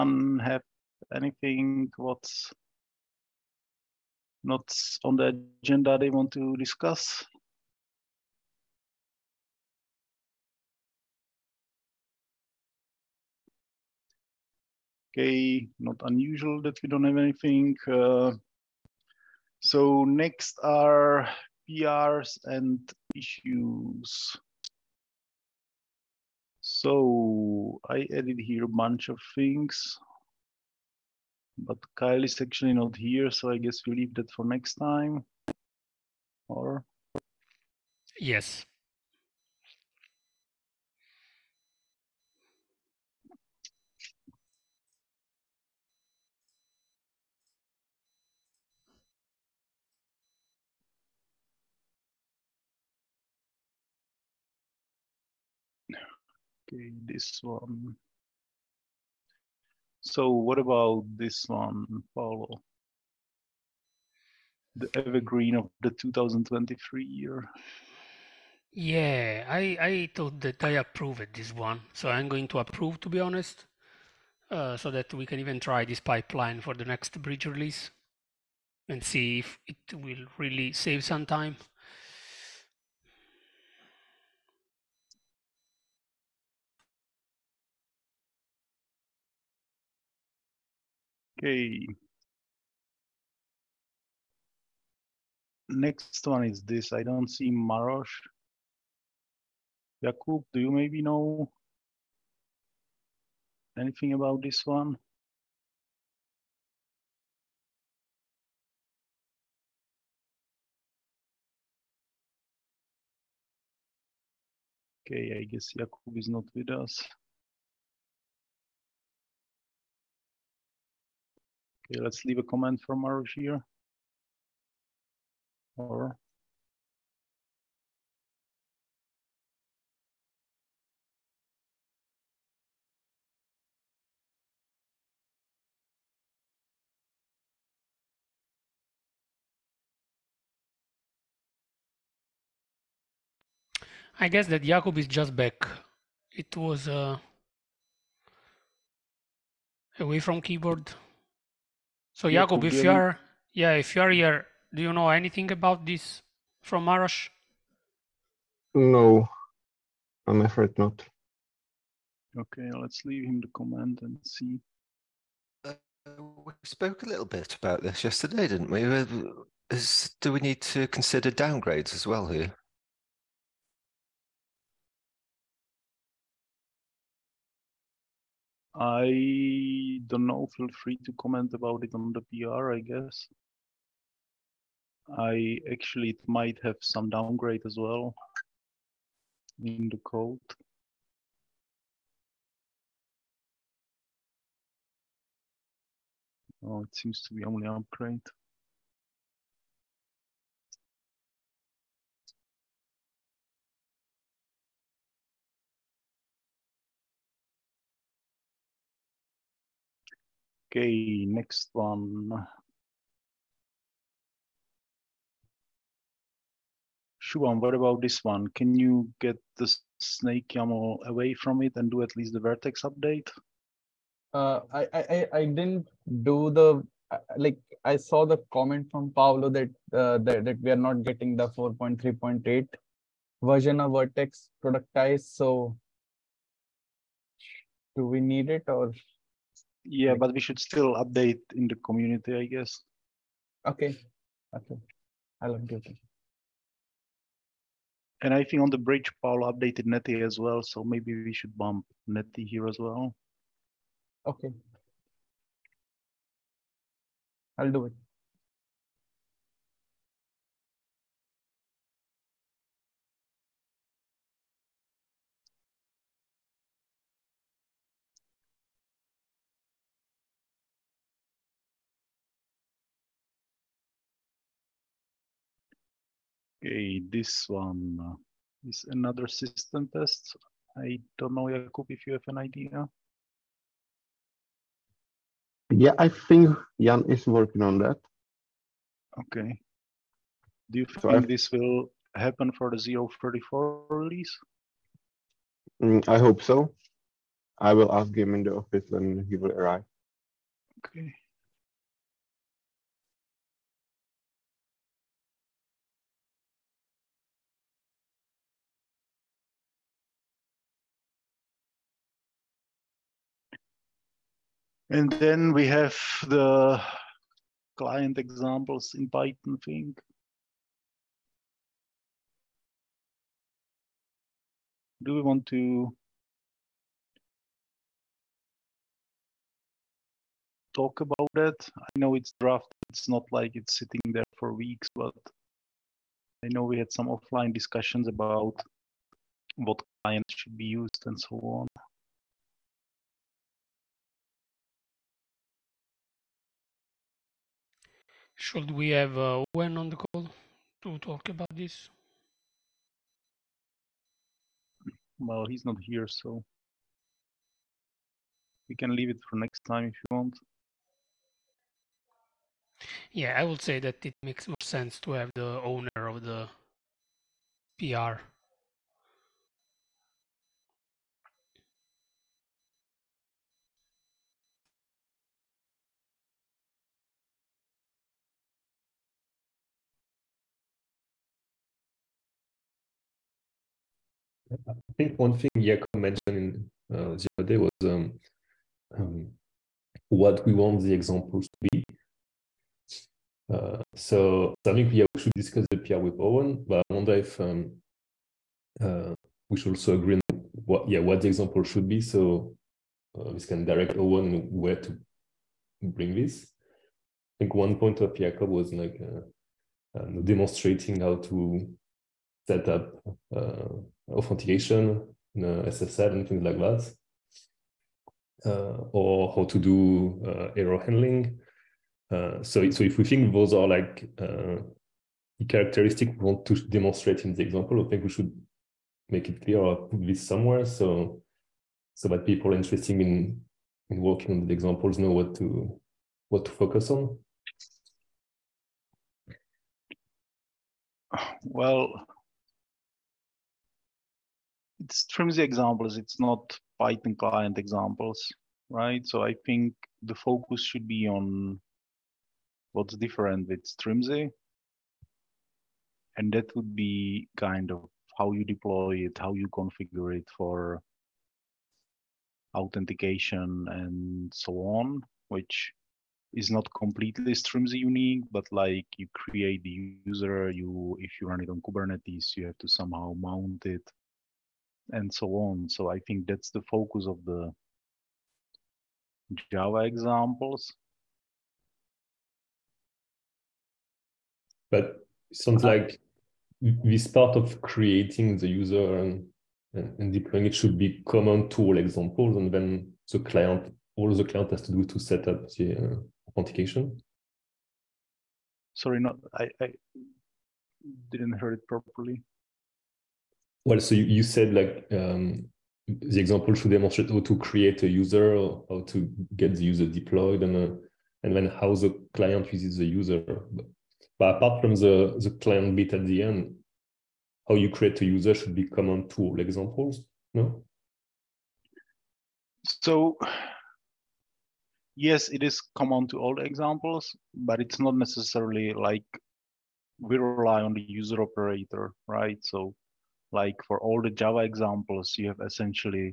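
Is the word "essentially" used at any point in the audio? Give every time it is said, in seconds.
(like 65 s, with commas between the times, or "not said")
535 s.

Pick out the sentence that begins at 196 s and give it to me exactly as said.
Oh, it seems to be only upgrade.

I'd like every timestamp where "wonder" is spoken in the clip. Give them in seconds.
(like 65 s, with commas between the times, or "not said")
396 s.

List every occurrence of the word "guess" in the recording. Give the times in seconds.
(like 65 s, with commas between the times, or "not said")
33 s, 115 s, 144 s, 182 s, 242 s.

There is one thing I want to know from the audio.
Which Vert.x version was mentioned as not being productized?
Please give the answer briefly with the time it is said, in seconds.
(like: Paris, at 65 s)
4.3.8, at 231 s.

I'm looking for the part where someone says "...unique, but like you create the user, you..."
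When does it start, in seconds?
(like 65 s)
467 s.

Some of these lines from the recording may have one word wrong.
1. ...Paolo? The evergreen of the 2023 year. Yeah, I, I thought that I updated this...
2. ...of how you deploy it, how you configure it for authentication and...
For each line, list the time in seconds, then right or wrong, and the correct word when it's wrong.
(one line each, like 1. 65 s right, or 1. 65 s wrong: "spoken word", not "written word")
1. 62 s wrong: "approved", not "updated"
2. 457 s right.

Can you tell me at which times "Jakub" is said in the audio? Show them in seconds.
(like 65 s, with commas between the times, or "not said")
100 s, 115 s, 144 s, 152 s, 281 s, 385 s, 408 s.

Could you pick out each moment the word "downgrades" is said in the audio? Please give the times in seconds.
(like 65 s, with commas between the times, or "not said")
171 s, 187 s.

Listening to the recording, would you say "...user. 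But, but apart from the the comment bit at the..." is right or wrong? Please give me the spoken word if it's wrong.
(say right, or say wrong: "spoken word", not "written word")
wrong: "client", not "comment".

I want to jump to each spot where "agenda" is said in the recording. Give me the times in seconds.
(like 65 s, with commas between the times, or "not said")
5 s.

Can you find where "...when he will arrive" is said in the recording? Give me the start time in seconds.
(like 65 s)
298 s.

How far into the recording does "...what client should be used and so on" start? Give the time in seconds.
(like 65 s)
339 s.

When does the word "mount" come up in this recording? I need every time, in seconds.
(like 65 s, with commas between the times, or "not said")
473 s.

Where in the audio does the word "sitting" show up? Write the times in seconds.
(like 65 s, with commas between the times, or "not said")
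333 s.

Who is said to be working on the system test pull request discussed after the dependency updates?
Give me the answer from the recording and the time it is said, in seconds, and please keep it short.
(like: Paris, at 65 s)
Jan, at 286 s.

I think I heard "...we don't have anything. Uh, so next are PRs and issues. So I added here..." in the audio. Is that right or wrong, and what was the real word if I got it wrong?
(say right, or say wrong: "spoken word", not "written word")
right.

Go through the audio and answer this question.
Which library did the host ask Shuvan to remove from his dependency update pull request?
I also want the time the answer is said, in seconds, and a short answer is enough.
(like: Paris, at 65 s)
snake YAML, at 219 s.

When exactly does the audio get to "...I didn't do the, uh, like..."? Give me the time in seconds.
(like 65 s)
225 s.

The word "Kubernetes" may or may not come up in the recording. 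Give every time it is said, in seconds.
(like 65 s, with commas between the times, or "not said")
471 s.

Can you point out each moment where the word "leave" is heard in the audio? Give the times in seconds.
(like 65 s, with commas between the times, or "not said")
33 s, 122 s, 163 s, 358 s.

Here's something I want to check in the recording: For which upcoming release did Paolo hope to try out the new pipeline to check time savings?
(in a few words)
bridge release.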